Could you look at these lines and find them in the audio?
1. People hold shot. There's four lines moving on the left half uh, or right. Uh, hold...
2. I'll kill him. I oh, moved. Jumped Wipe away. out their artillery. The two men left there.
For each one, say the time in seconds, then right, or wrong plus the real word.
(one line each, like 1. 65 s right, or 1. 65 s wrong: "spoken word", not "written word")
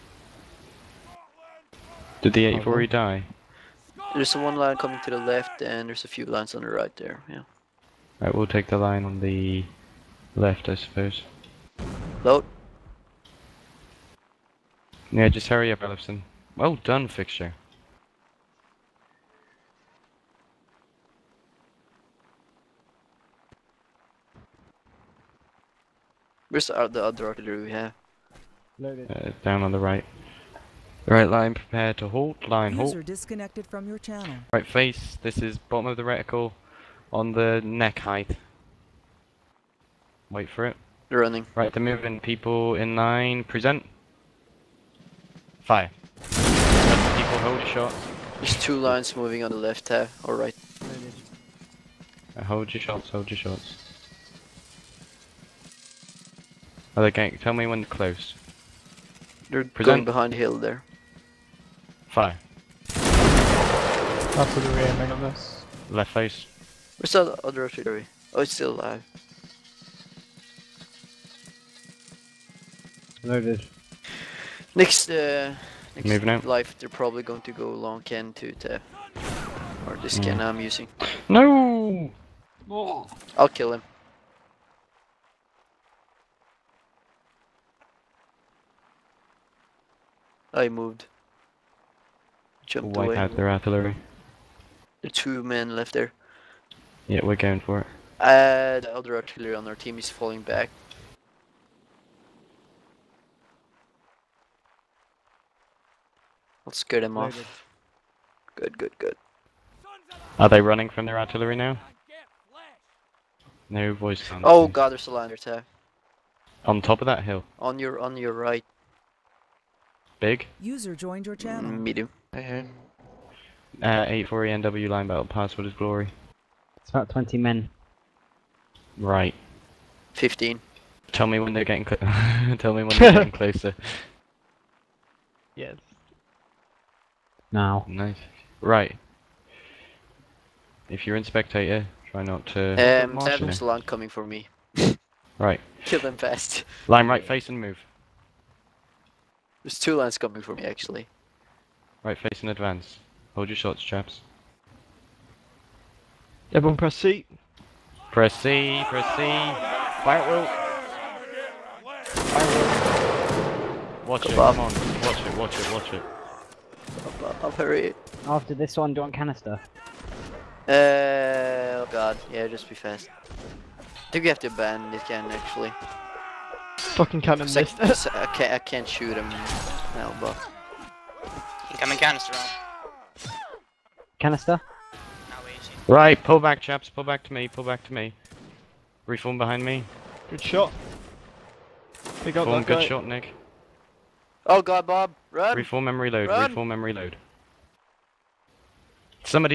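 1. 46 s wrong: "two", not "four"
2. 83 s right.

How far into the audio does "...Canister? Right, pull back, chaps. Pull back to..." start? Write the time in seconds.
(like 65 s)
184 s.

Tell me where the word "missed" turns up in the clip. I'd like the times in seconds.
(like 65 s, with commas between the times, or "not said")
177 s.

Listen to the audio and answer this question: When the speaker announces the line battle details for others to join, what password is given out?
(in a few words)
glory.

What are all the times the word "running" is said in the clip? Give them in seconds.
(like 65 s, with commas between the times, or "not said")
41 s, 110 s.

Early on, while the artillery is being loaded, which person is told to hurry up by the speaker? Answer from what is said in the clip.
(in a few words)
Ellison.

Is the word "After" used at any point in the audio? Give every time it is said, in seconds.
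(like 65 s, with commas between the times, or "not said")
62 s, 168 s.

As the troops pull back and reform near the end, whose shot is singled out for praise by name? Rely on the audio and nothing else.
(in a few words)
Nick.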